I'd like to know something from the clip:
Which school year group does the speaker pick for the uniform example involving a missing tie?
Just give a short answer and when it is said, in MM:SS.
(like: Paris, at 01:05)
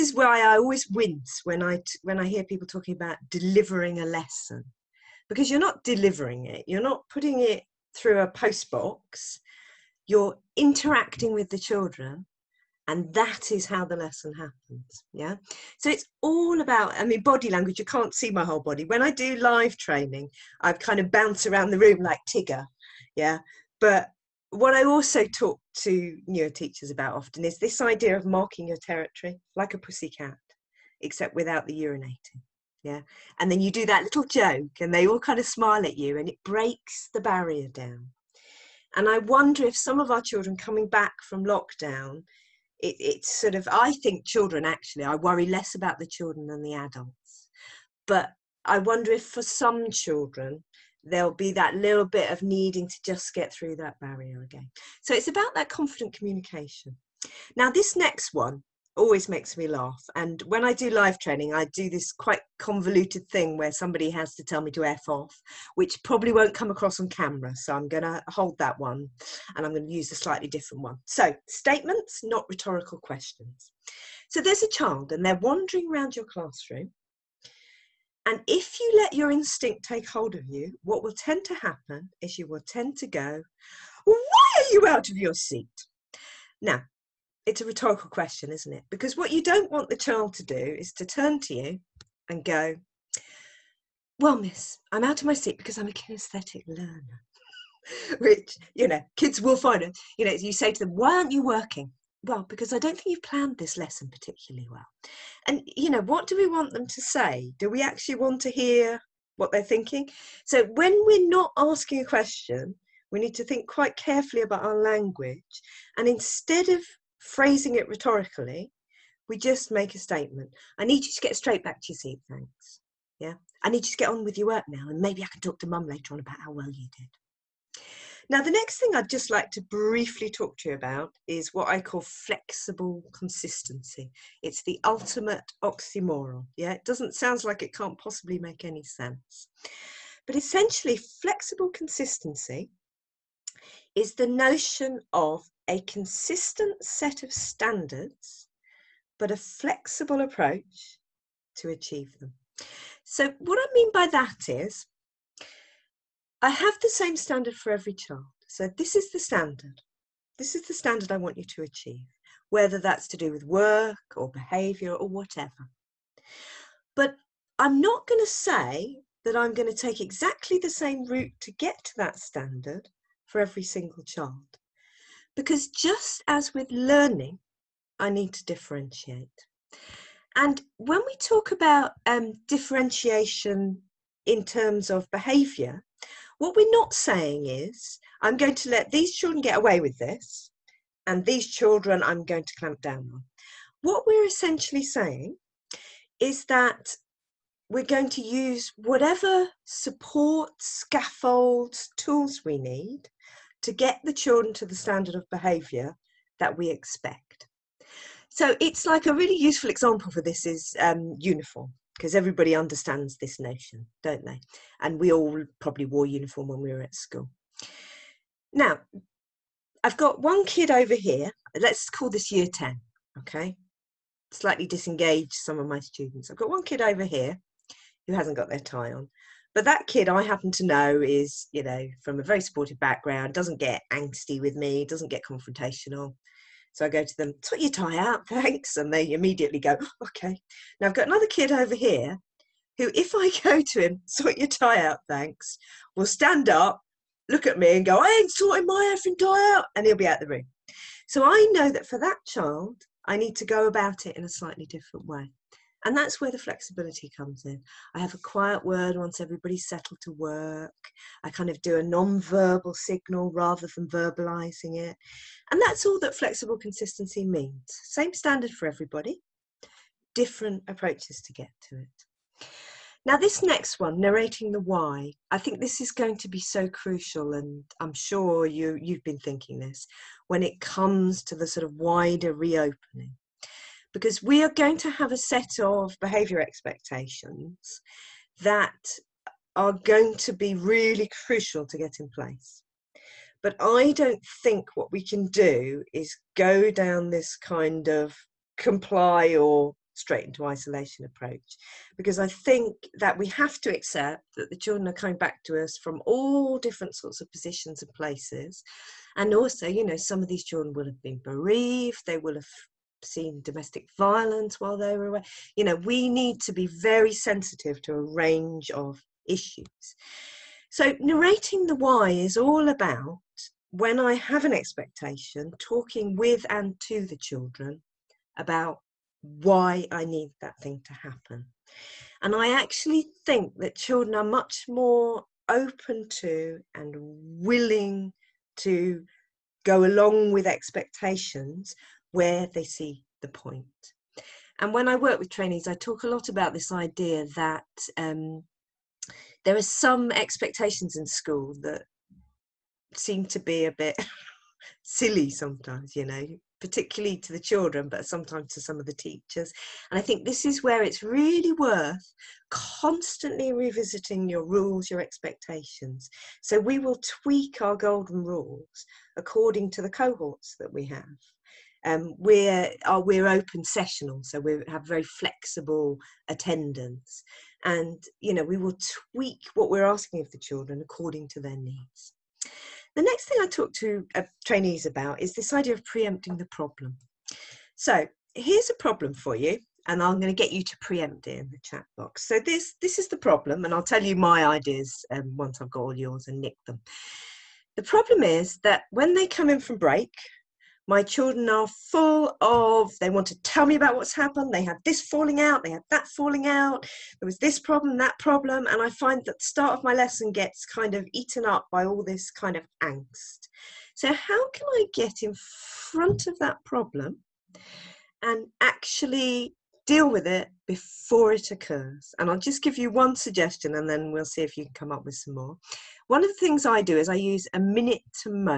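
Year 10, at 03:42.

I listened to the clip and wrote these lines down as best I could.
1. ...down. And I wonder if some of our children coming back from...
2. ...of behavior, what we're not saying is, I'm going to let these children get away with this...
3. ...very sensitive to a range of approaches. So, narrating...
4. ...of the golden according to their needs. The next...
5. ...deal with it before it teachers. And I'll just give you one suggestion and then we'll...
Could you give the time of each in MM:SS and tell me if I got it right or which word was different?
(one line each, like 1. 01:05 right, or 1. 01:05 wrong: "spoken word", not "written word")
1. 00:37 right
2. 03:04 right
3. 05:16 wrong: "issues", not "approaches"
4. 06:20 wrong: "children", not "golden"
5. 06:59 wrong: "occurs", not "teachers".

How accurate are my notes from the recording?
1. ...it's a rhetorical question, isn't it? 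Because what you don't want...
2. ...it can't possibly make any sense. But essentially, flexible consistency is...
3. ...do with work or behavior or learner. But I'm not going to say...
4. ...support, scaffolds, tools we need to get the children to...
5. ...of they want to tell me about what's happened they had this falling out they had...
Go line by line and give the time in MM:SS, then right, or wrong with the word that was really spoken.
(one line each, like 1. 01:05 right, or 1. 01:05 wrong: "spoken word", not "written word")
1. 01:27 right
2. 02:17 right
3. 02:43 wrong: "whatever", not "learner"
4. 03:19 right
5. 06:42 right.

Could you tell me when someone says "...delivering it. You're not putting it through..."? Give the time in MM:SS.
00:05.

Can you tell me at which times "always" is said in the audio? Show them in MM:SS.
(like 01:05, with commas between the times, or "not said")
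00:00, 00:58.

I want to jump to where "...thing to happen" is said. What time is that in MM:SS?
05:30.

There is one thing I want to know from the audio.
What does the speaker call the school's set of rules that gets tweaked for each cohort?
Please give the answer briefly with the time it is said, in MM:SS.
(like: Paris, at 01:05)
golden rules, at 06:07.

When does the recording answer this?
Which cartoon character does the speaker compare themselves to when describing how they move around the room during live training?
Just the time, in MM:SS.
00:22.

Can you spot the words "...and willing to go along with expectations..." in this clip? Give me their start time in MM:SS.
05:36.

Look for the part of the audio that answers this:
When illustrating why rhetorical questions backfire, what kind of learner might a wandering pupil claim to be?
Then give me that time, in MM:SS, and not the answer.
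01:35.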